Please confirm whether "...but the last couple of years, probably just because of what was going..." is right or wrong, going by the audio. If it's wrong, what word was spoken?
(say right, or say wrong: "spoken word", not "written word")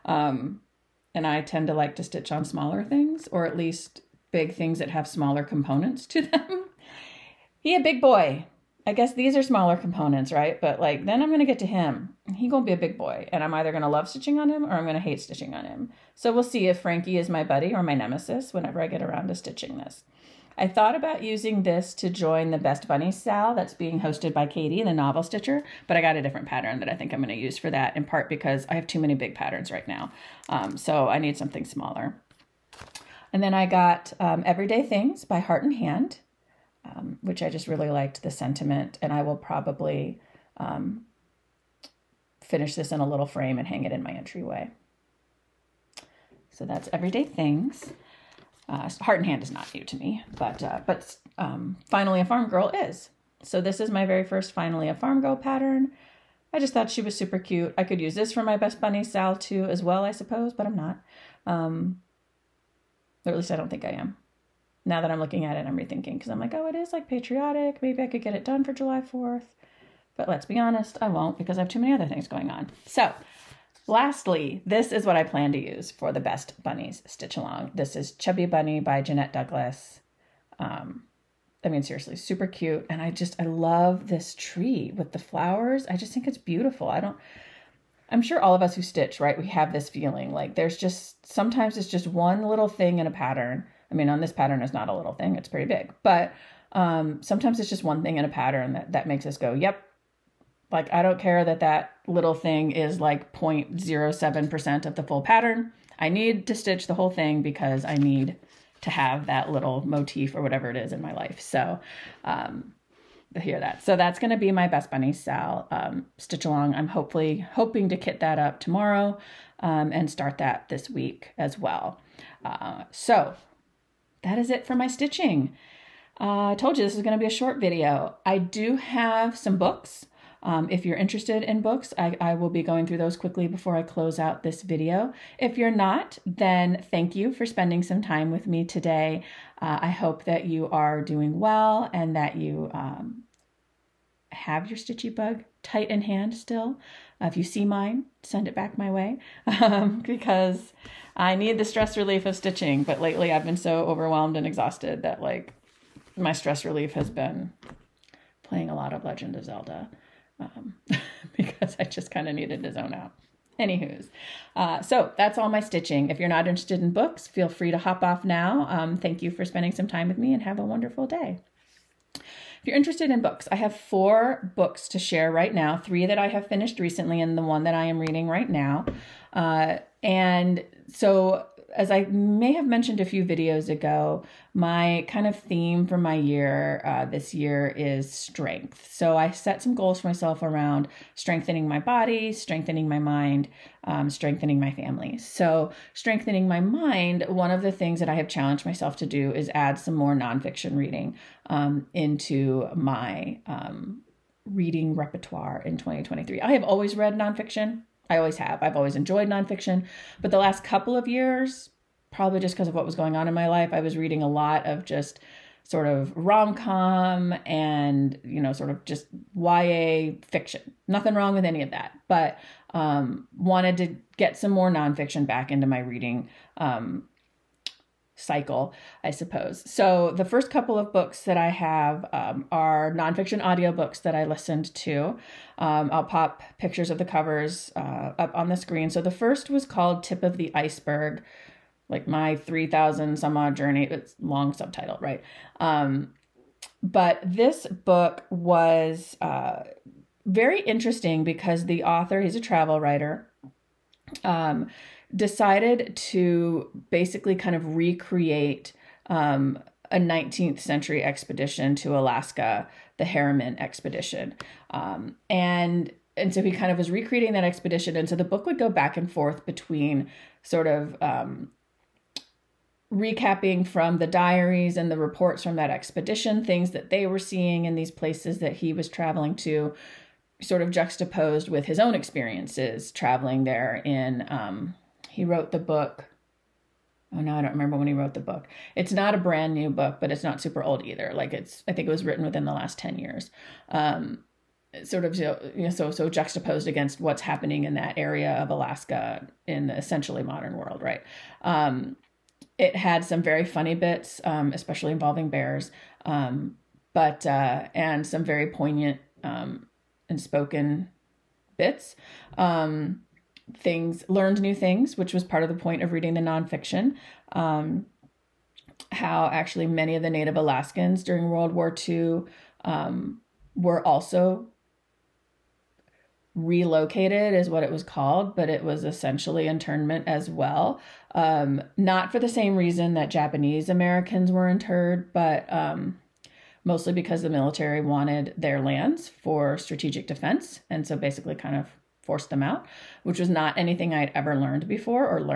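right.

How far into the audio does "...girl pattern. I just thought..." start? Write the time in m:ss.
0:55.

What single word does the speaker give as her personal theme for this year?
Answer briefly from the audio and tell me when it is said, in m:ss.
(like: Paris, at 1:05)
strength, at 3:08.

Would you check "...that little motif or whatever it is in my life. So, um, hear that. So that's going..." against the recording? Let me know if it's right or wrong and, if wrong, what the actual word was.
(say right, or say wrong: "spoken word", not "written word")
right.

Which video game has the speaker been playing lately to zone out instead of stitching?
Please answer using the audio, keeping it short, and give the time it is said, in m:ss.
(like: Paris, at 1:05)
Legend of Zelda, at 2:39.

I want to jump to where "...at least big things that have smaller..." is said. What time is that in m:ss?
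0:03.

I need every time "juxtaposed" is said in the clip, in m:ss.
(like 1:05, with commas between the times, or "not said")
4:40, 4:56.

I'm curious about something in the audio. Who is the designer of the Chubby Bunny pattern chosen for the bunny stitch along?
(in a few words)
Jeanette Douglas.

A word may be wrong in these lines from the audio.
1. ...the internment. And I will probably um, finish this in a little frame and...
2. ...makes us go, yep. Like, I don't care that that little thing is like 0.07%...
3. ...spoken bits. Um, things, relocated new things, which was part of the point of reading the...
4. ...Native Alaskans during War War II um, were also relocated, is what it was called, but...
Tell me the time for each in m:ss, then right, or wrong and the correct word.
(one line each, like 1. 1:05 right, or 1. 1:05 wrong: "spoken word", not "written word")
1. 0:38 wrong: "sentiment", not "internment"
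2. 1:39 right
3. 5:10 wrong: "learned", not "relocated"
4. 5:20 wrong: "World", not "War".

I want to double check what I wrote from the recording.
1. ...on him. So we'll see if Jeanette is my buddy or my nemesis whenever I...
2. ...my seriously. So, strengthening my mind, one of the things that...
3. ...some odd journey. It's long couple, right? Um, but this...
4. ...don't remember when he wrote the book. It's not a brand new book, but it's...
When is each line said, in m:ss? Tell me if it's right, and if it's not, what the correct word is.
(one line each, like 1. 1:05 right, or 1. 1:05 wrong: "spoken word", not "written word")
1. 0:15 wrong: "Frankie", not "Jeanette"
2. 3:14 wrong: "family", not "seriously"
3. 4:03 wrong: "subtitle", not "couple"
4. 4:47 right.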